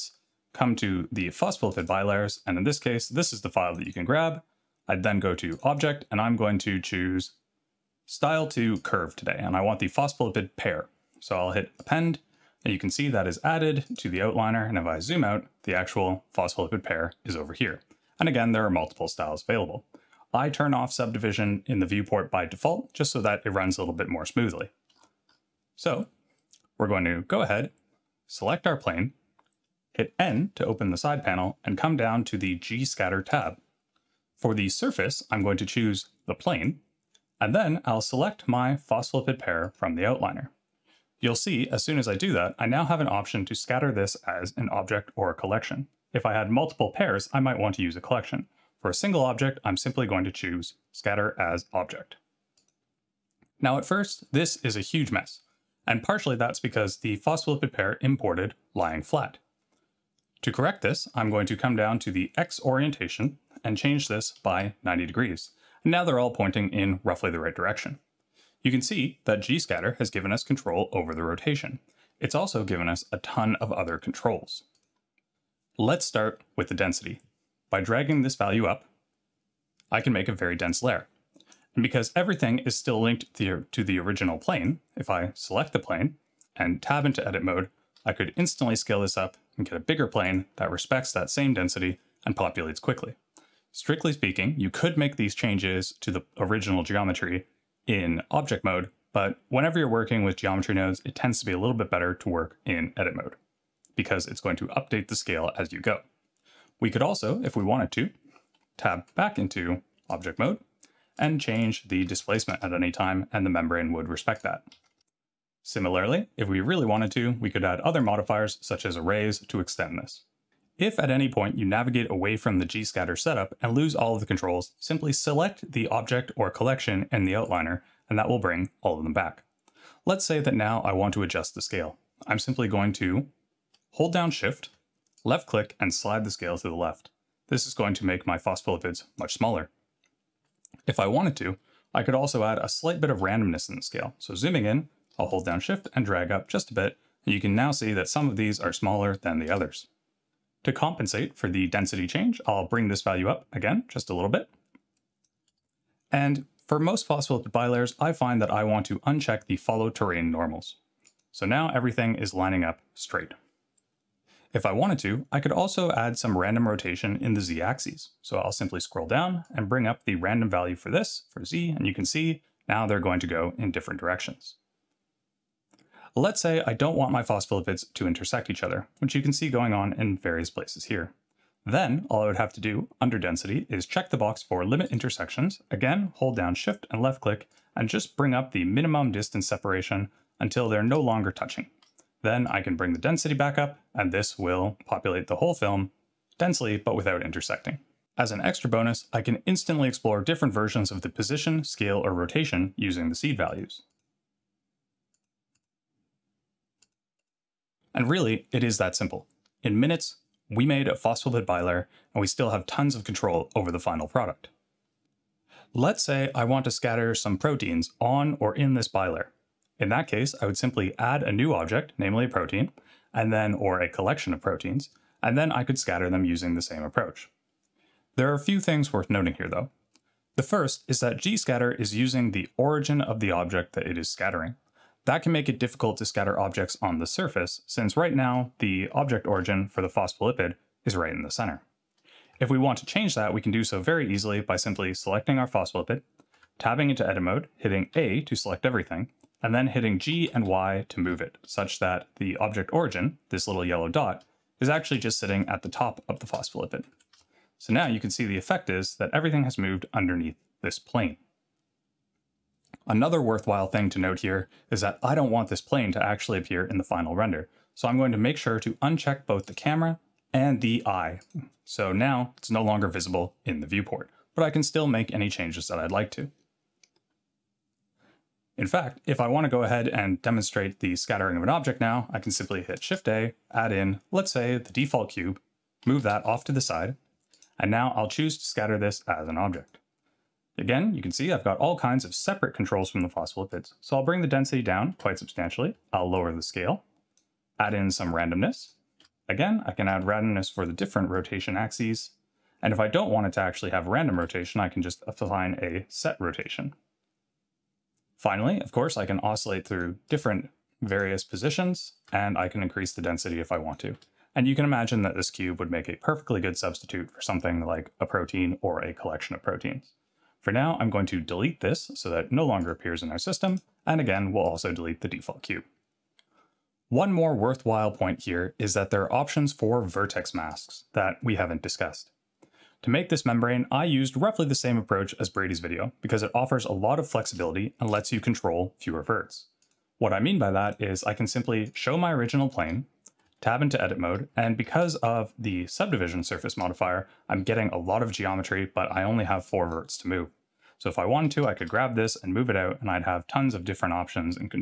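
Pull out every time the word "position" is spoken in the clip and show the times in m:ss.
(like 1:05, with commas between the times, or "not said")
3:21, 5:11.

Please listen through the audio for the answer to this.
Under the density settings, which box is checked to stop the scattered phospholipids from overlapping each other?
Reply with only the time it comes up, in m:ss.
3:04.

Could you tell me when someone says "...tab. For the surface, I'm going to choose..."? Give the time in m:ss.
0:33.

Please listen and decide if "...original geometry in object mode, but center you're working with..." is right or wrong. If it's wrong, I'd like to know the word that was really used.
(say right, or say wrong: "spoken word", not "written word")
wrong: "whenever", not "center".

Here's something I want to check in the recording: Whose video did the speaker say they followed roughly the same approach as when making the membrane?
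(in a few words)
Brady.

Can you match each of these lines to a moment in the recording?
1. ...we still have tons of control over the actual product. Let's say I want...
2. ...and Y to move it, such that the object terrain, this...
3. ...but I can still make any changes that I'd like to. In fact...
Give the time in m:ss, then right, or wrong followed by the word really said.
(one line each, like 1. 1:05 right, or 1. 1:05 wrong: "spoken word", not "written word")
1. 3:32 wrong: "final", not "actual"
2. 4:10 wrong: "origin", not "terrain"
3. 4:34 right.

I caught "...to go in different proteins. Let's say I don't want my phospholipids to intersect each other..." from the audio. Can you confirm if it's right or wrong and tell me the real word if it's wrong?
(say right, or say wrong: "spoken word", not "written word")
wrong: "directions", not "proteins".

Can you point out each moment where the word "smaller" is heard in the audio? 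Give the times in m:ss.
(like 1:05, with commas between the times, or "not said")
2:19, 2:28.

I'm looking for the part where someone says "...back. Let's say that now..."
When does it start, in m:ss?
2:09.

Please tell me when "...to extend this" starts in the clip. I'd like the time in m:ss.
1:59.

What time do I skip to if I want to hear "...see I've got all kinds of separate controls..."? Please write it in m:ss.
4:51.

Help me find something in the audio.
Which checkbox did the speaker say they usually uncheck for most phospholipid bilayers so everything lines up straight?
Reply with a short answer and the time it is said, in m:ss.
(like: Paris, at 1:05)
follow terrain normals, at 2:39.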